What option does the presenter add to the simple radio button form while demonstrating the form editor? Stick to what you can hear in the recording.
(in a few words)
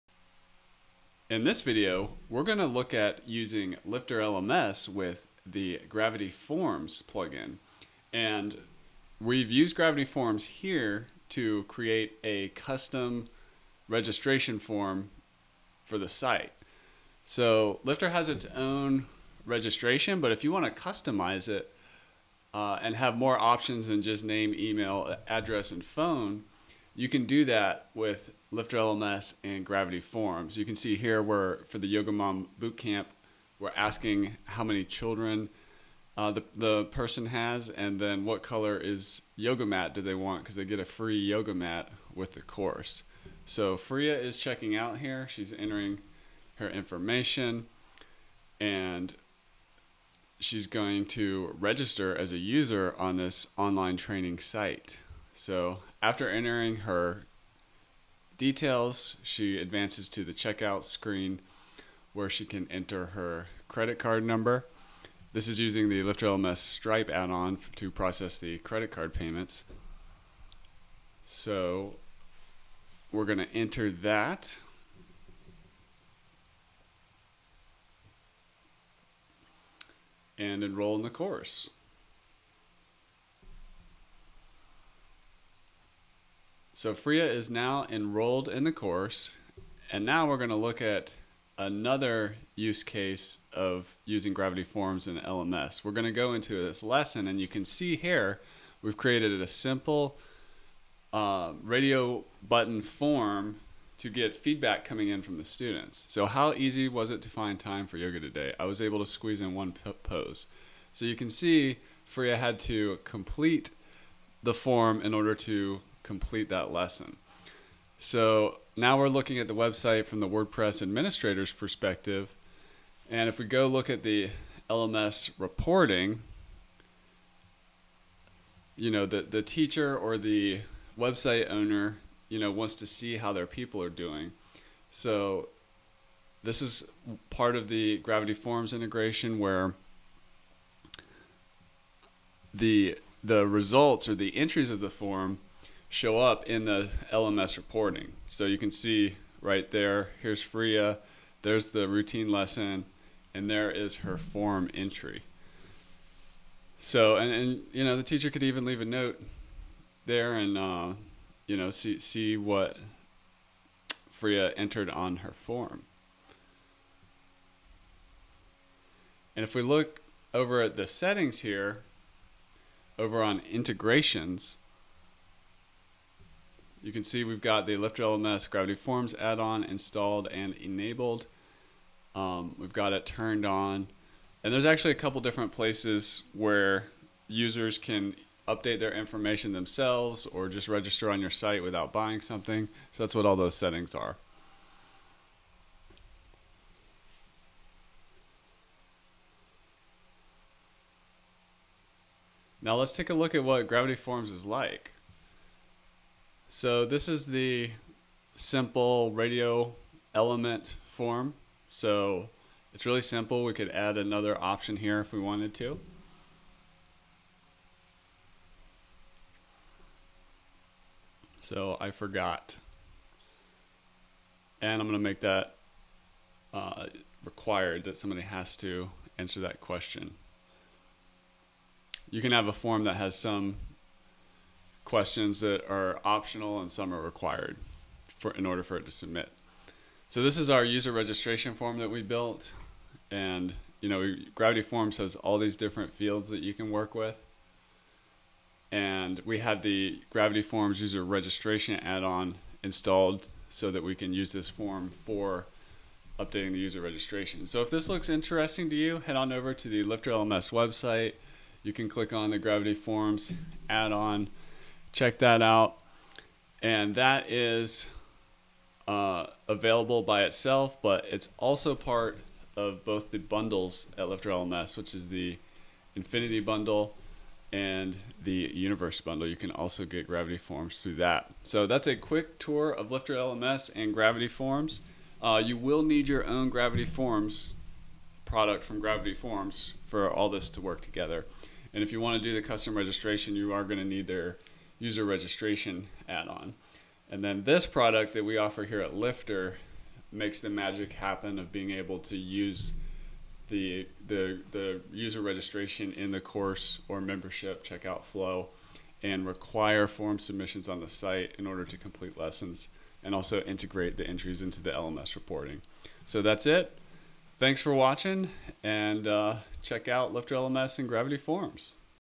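I forgot.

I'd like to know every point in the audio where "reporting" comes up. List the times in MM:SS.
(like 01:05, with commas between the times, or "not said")
02:05, 02:27, 05:15.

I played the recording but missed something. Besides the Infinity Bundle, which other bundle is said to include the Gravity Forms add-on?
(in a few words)
Universe Bundle.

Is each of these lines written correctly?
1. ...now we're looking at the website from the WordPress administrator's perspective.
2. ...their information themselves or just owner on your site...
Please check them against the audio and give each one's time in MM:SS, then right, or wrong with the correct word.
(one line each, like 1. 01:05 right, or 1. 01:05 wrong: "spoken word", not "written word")
1. 01:58 right
2. 03:08 wrong: "register", not "owner".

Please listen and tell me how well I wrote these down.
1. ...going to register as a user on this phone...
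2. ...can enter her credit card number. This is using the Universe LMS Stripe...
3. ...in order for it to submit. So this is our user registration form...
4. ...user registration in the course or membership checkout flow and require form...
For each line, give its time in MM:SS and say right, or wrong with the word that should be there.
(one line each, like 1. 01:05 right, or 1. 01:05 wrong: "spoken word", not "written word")
1. 00:50 wrong: "online", not "phone"
2. 01:02 wrong: "Lifter", not "Universe"
3. 03:58 right
4. 05:04 right.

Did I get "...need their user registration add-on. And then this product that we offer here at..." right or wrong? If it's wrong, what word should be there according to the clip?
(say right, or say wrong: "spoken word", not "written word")
right.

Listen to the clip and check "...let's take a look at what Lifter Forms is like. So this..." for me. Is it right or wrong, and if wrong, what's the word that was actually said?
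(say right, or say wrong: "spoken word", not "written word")
wrong: "Gravity", not "Lifter".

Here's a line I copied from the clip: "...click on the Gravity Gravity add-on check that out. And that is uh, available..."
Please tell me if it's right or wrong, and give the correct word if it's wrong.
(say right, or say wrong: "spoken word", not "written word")
wrong: "Forms", not "Gravity".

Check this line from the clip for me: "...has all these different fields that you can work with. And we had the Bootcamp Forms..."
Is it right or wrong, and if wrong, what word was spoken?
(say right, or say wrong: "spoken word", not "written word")
wrong: "Gravity", not "Bootcamp".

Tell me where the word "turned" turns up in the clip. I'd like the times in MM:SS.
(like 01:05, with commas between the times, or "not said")
03:03.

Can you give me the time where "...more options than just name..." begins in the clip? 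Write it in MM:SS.
00:23.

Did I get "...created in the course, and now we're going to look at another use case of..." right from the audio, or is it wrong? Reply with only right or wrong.
wrong.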